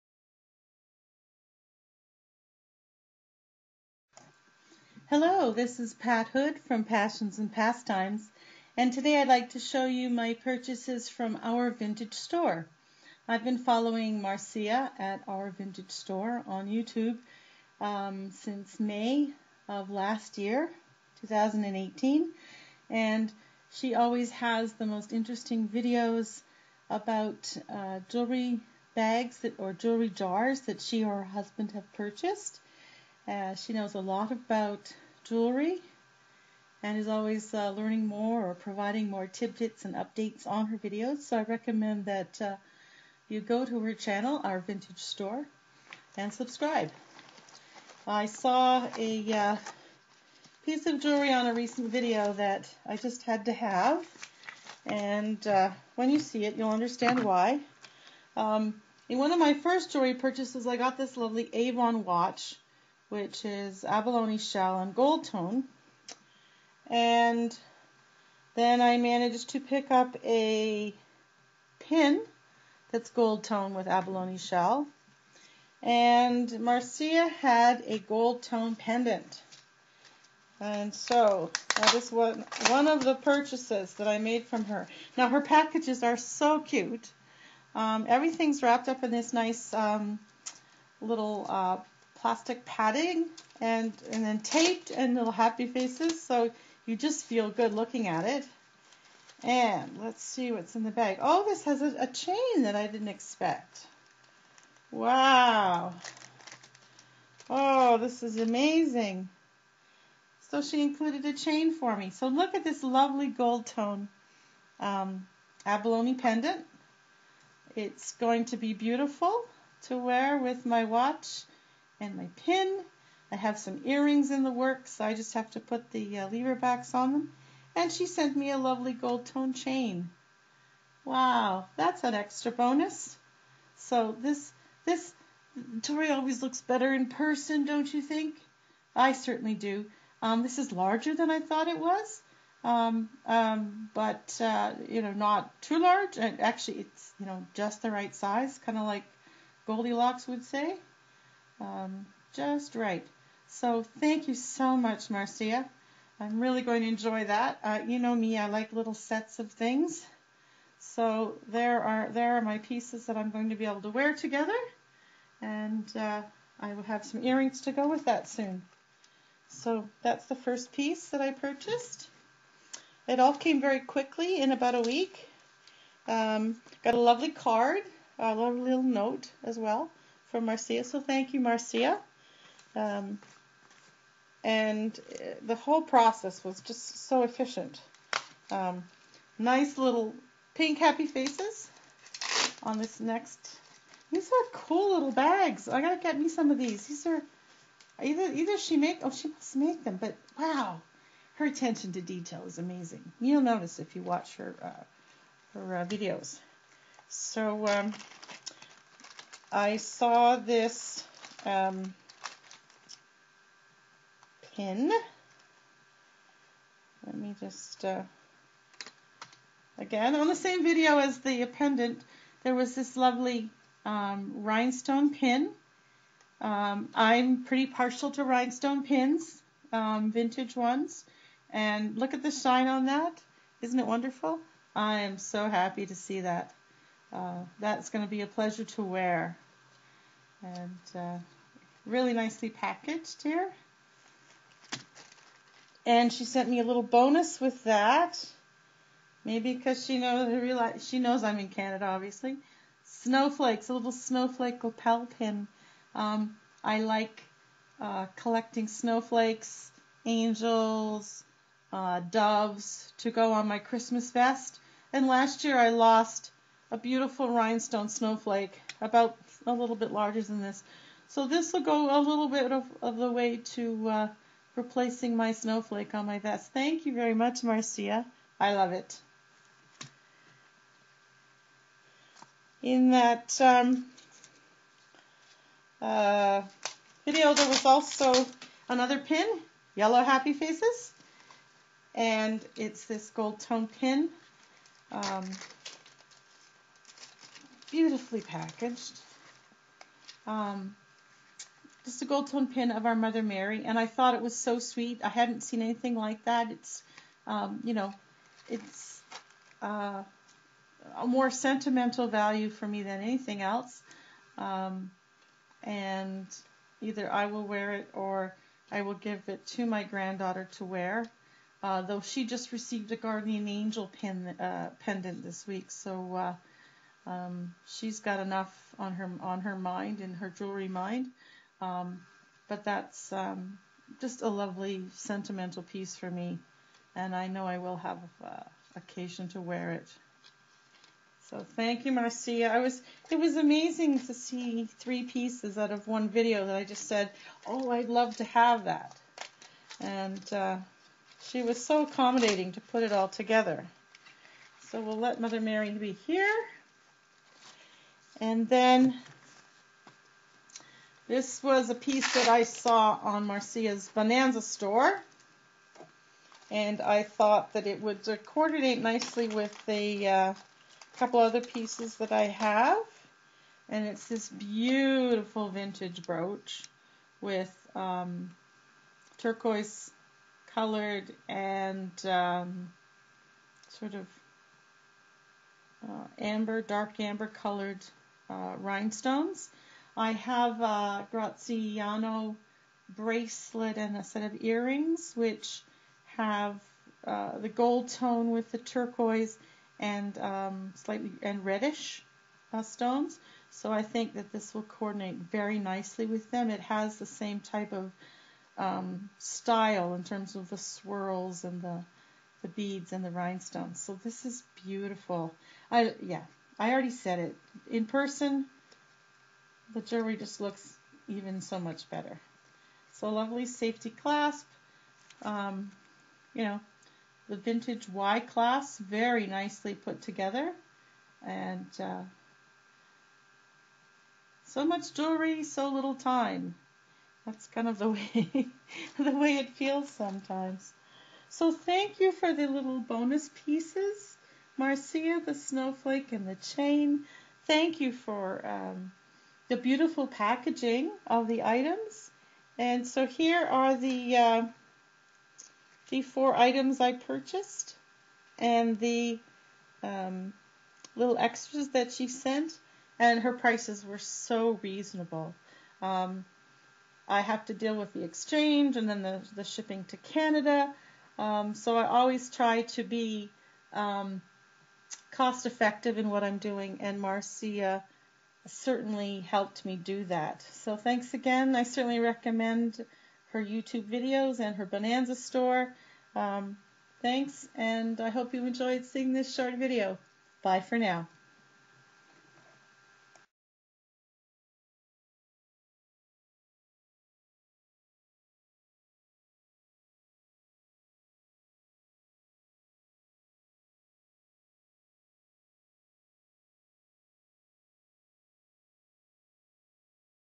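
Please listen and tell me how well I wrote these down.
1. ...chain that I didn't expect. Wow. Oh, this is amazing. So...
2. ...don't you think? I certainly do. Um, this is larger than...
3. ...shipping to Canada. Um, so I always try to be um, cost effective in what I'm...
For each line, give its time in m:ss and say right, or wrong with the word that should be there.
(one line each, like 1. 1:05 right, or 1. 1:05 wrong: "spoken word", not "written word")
1. 1:42 right
2. 2:17 right
3. 7:49 right.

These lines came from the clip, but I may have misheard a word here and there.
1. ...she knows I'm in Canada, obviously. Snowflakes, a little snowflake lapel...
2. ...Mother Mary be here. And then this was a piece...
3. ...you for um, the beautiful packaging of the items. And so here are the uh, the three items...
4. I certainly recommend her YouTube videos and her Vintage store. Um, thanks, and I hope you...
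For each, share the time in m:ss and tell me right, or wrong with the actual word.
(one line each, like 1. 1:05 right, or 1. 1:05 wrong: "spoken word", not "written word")
1. 4:10 right
2. 5:55 right
3. 7:27 wrong: "four", not "three"
4. 8:01 wrong: "Bonanza", not "Vintage".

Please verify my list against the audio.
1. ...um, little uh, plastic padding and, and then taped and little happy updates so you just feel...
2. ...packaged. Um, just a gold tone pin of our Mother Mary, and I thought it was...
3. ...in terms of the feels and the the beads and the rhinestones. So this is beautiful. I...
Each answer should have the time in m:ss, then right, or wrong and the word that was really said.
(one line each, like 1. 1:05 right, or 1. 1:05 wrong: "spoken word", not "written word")
1. 1:29 wrong: "faces", not "updates"
2. 4:58 right
3. 6:49 wrong: "swirls", not "feels".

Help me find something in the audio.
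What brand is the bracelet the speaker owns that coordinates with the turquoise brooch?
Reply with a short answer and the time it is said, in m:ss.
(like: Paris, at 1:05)
Graziano, at 6:31.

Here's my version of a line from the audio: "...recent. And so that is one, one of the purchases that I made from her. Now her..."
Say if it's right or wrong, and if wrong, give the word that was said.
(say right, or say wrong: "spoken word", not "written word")
wrong: "pendant", not "recent".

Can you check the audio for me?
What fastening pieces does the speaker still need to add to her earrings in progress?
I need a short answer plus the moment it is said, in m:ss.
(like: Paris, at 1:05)
Lever backs, at 2:06.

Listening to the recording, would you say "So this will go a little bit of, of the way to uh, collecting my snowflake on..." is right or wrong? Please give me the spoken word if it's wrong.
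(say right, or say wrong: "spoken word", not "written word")
wrong: "replacing", not "collecting".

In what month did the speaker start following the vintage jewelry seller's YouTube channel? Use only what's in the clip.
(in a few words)
May.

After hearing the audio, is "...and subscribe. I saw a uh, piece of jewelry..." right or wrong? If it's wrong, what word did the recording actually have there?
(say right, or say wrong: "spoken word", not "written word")
right.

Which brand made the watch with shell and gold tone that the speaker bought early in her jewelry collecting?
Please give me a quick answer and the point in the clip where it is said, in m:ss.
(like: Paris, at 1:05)
Avon, at 1:01.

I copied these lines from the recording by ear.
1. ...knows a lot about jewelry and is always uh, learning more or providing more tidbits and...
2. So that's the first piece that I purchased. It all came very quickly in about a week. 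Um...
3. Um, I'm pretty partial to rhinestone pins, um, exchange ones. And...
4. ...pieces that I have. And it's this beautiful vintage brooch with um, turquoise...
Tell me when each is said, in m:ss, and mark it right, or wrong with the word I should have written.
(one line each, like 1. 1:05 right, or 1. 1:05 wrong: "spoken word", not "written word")
1. 0:33 right
2. 2:49 right
3. 3:46 wrong: "vintage", not "exchange"
4. 6:11 right.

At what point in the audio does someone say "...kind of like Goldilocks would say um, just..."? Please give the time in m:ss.
2:28.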